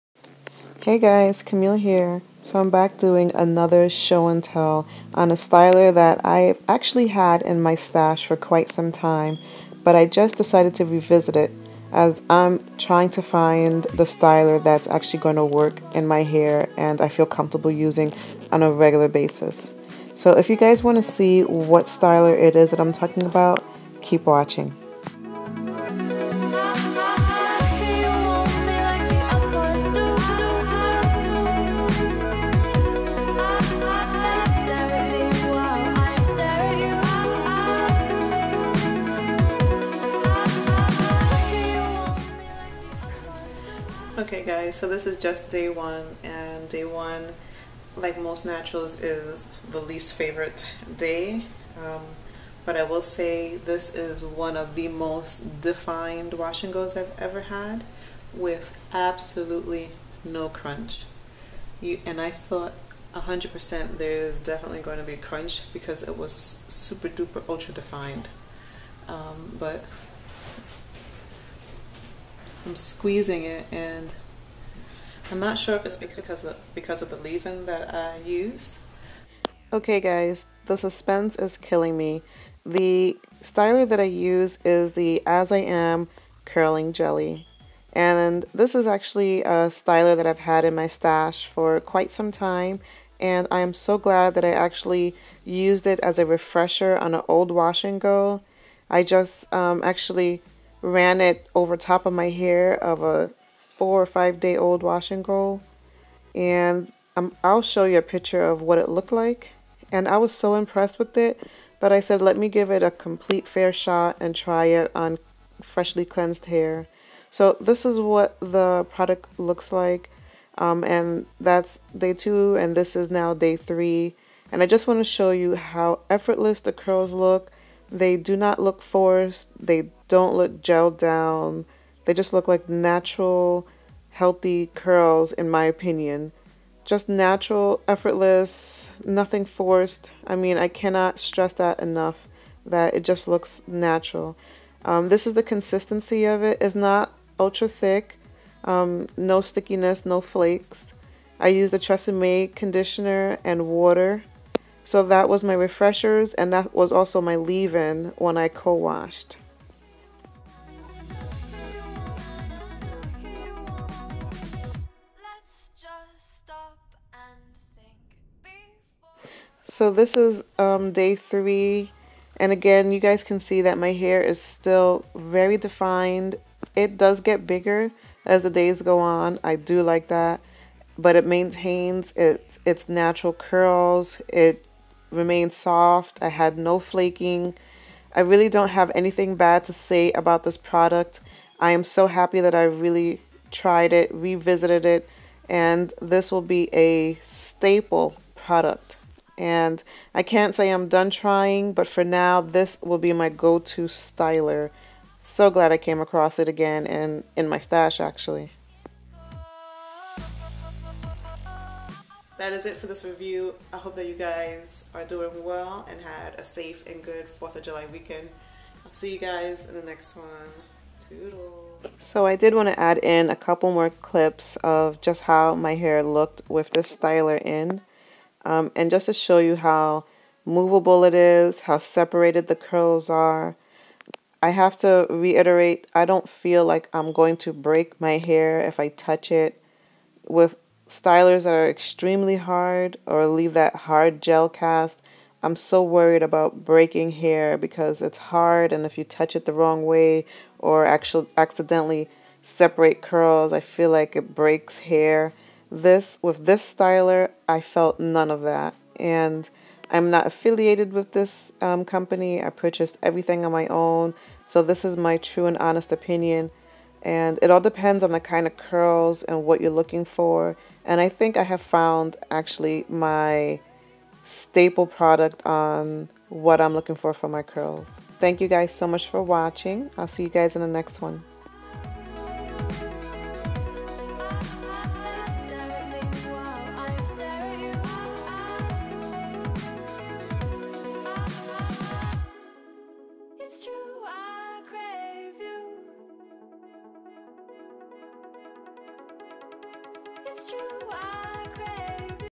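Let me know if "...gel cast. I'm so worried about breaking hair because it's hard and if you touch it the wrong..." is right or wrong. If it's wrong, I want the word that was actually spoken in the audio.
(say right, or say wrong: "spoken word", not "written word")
right.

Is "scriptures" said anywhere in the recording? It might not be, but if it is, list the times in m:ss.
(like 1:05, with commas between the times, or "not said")
not said.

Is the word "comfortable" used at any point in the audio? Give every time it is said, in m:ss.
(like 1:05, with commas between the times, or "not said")
0:17.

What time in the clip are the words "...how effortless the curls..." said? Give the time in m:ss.
2:05.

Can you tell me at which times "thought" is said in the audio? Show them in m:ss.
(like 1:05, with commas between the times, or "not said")
1:02.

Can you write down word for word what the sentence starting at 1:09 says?
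Um, but I'm squeezing it and I'm not sure if it's because of, because of the leave-in that I use.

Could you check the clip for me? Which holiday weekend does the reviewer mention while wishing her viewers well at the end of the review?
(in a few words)
4th of July.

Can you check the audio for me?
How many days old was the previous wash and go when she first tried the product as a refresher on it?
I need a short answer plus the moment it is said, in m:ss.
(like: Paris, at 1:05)
4 or 5, at 1:43.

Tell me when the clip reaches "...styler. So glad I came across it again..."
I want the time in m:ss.
3:23.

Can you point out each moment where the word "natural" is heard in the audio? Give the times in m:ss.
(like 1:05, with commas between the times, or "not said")
0:48, 2:12, 2:17, 2:23, 3:02.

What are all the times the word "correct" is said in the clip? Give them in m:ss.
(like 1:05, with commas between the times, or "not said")
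not said.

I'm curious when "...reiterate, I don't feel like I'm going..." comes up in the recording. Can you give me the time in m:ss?
3:55.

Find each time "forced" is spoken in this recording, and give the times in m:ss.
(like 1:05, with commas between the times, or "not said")
2:08, 2:19.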